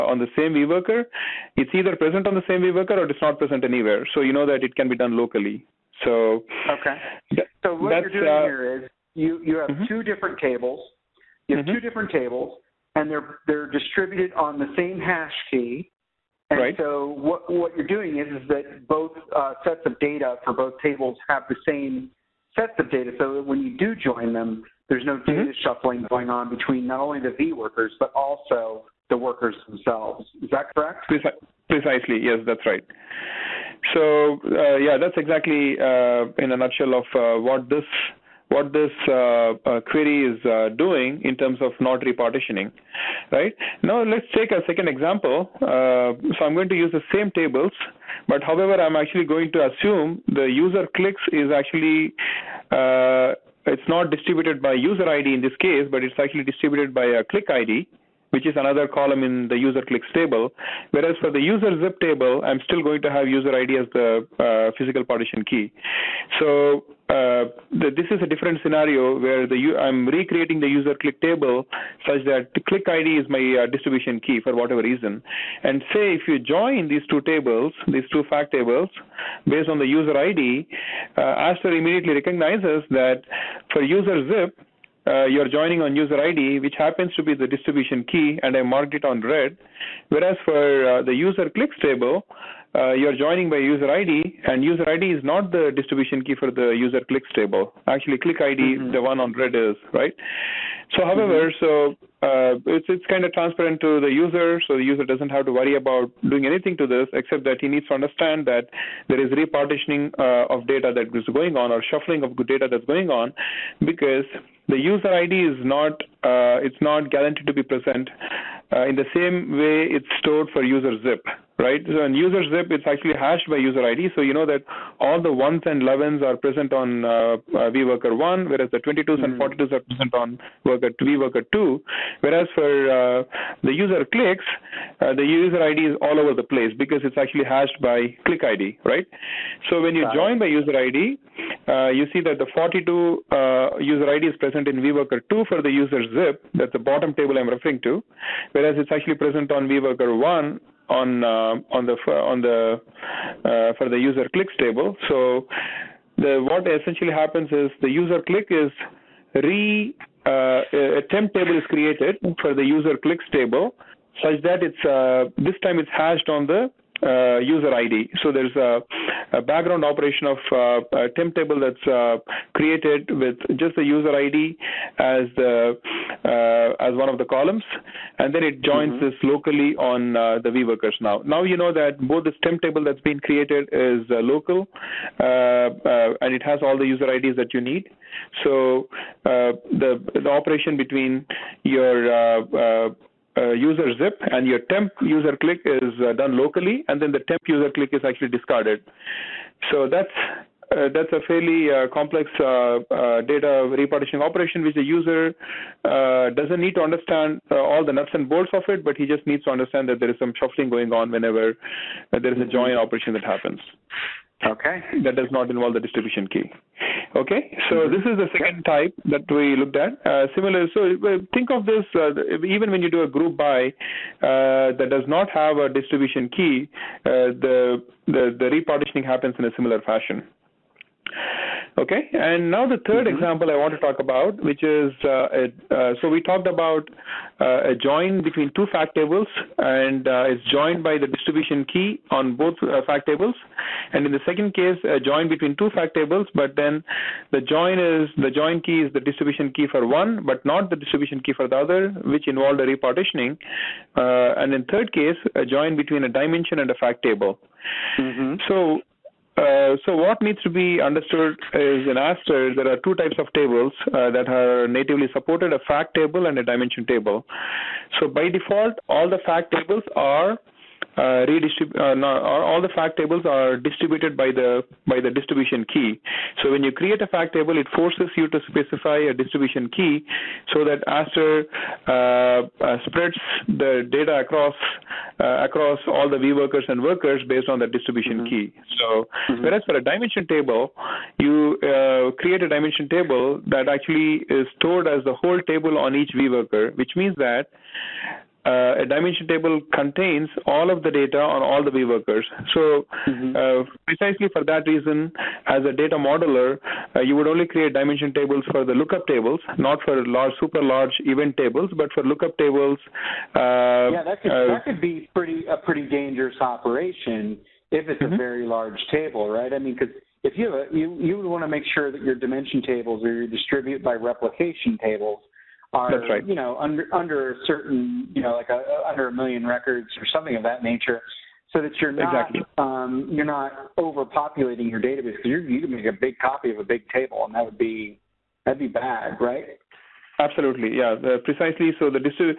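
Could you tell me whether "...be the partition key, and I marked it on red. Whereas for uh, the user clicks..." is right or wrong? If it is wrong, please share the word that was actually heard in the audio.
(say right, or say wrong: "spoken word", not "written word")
wrong: "distribution", not "partition".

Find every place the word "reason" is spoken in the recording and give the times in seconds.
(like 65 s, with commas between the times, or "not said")
74 s, 304 s.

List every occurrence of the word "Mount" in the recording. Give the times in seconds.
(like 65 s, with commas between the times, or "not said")
not said.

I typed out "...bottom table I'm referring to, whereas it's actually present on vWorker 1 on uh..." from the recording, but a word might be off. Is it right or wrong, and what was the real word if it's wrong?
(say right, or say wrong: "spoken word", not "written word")
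right.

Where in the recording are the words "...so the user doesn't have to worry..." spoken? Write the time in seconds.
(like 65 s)
104 s.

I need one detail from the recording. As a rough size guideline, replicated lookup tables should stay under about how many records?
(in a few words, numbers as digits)
1,000,000.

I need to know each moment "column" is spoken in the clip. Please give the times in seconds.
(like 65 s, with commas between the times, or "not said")
58 s, 177 s.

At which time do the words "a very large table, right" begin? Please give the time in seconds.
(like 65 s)
318 s.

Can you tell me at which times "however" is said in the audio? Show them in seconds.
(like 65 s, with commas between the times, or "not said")
48 s, 101 s.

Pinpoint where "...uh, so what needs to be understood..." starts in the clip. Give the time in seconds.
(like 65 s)
259 s.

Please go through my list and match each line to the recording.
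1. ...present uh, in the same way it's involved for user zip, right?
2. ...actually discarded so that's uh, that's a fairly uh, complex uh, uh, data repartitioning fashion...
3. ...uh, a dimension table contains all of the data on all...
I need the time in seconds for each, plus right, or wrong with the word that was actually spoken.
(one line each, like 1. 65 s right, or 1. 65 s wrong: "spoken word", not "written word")
1. 117 s wrong: "stored", not "involved"
2. 198 s wrong: "operation", not "fashion"
3. 298 s right.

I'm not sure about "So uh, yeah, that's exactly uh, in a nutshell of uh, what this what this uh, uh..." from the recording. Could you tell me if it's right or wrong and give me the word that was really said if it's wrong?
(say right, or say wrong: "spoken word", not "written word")
right.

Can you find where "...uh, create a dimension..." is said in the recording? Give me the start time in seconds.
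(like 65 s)
291 s.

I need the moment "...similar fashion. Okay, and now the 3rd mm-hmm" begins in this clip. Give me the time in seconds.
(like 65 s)
229 s.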